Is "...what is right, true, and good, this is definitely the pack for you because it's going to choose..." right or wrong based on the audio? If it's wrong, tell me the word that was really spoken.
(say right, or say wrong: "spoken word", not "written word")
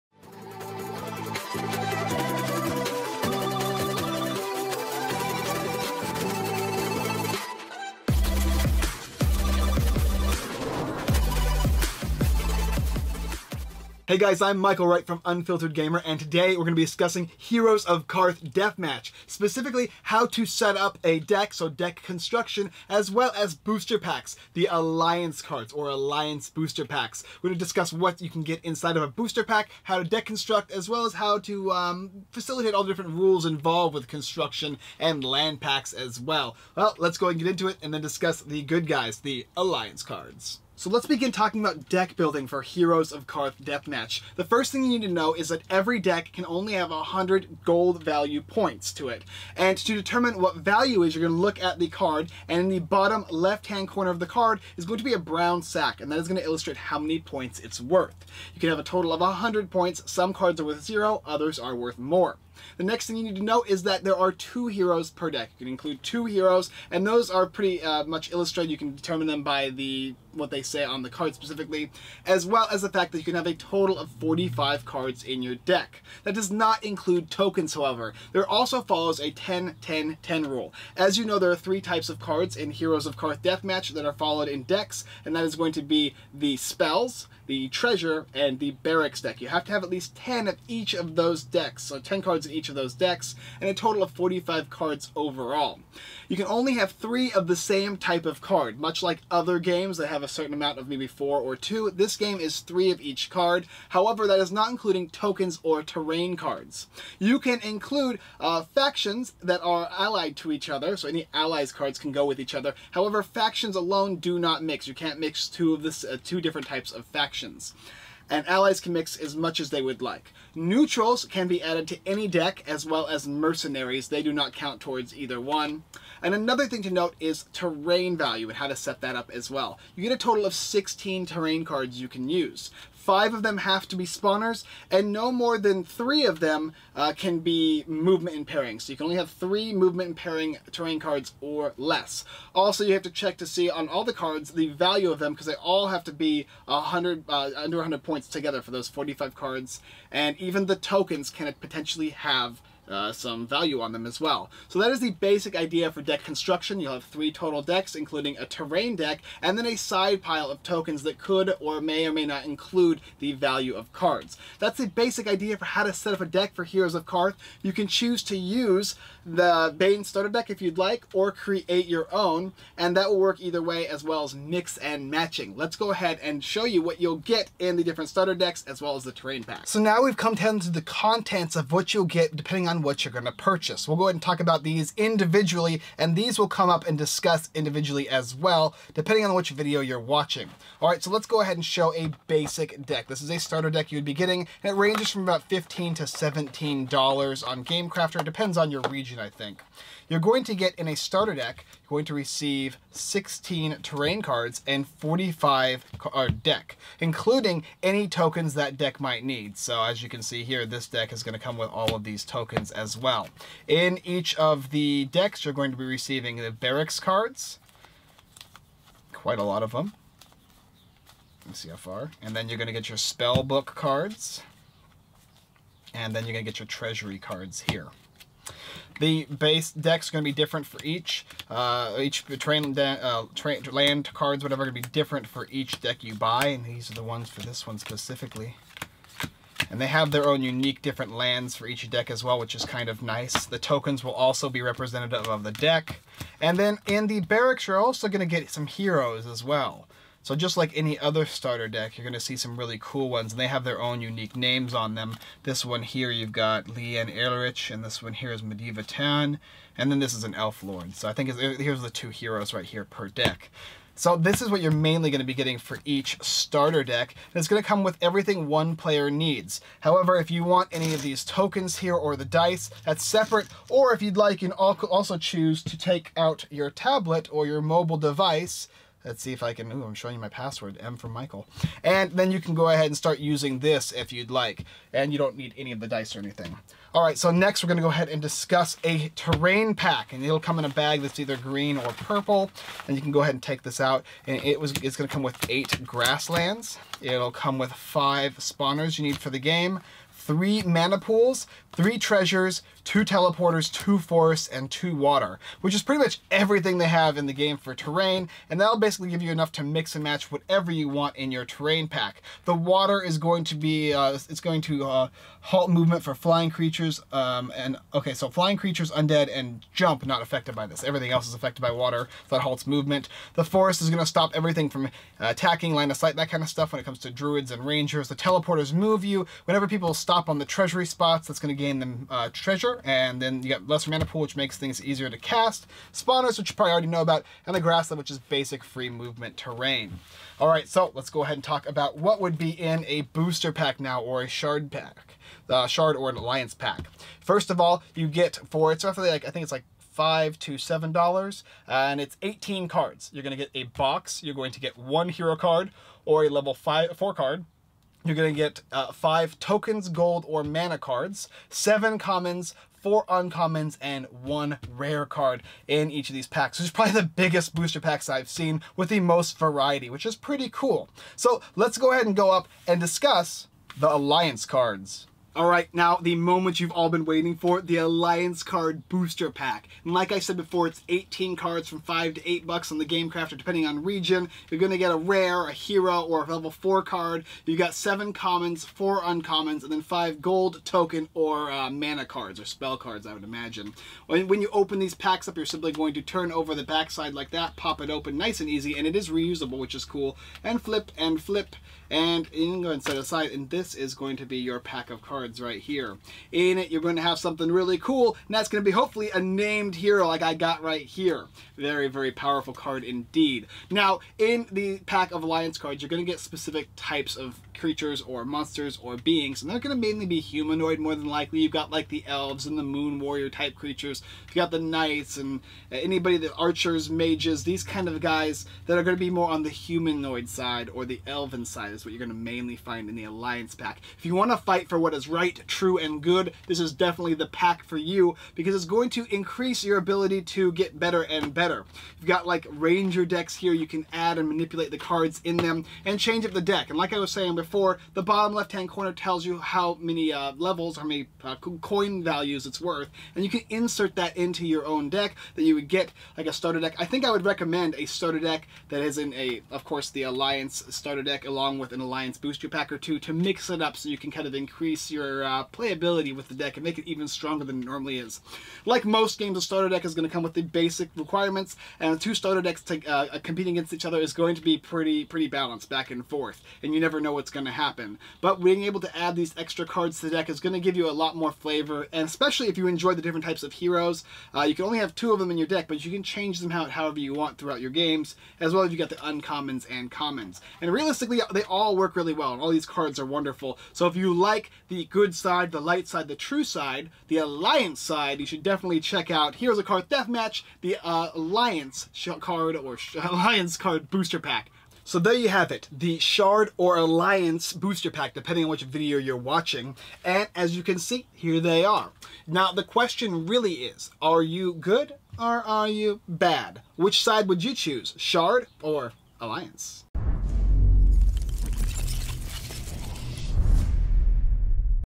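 wrong: "increase", not "choose".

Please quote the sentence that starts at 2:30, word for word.
And even the tokens can potentially have uh, some value on them as well.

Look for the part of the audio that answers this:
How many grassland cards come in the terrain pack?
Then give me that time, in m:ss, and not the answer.
4:55.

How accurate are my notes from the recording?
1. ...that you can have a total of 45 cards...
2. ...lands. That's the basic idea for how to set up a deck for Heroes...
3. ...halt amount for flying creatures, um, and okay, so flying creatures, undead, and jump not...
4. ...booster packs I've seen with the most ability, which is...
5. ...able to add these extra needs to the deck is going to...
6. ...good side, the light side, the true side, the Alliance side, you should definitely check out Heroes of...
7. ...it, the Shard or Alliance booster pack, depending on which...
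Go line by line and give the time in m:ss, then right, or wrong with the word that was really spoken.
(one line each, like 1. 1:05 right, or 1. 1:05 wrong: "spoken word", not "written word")
1. 1:13 right
2. 2:43 wrong: "cards", not "lands"
3. 5:15 wrong: "movement", not "amount"
4. 6:07 wrong: "variety", not "ability"
5. 7:58 wrong: "cards", not "needs"
6. 8:14 right
7. 8:25 right.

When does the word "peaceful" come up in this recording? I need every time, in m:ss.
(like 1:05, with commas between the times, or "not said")
not said.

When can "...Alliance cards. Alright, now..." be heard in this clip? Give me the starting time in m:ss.
6:13.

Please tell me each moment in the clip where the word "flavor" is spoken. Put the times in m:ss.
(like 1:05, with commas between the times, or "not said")
8:01.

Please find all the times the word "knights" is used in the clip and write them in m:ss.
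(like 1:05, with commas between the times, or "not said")
7:04.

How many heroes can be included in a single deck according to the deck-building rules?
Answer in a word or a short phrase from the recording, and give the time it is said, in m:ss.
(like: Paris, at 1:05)
2, at 1:04.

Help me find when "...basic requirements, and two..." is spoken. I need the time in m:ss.
7:50.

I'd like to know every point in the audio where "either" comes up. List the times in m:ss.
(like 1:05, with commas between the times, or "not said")
2:05, 2:53, 4:51.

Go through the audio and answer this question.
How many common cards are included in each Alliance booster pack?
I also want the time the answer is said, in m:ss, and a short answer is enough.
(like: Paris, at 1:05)
7, at 6:27.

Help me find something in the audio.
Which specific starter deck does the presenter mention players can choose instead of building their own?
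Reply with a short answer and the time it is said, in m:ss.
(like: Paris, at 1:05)
Bane starter deck, at 2:49.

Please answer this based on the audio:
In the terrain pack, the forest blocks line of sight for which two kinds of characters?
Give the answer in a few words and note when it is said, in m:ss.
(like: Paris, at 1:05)
Druids and rangers, at 5:27.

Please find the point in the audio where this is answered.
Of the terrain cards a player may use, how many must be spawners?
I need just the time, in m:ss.
2:13.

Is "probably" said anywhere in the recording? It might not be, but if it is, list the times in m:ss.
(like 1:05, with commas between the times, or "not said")
5:36, 6:06.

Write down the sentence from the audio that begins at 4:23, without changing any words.
So this is what you're mainly going to be getting for each starter deck.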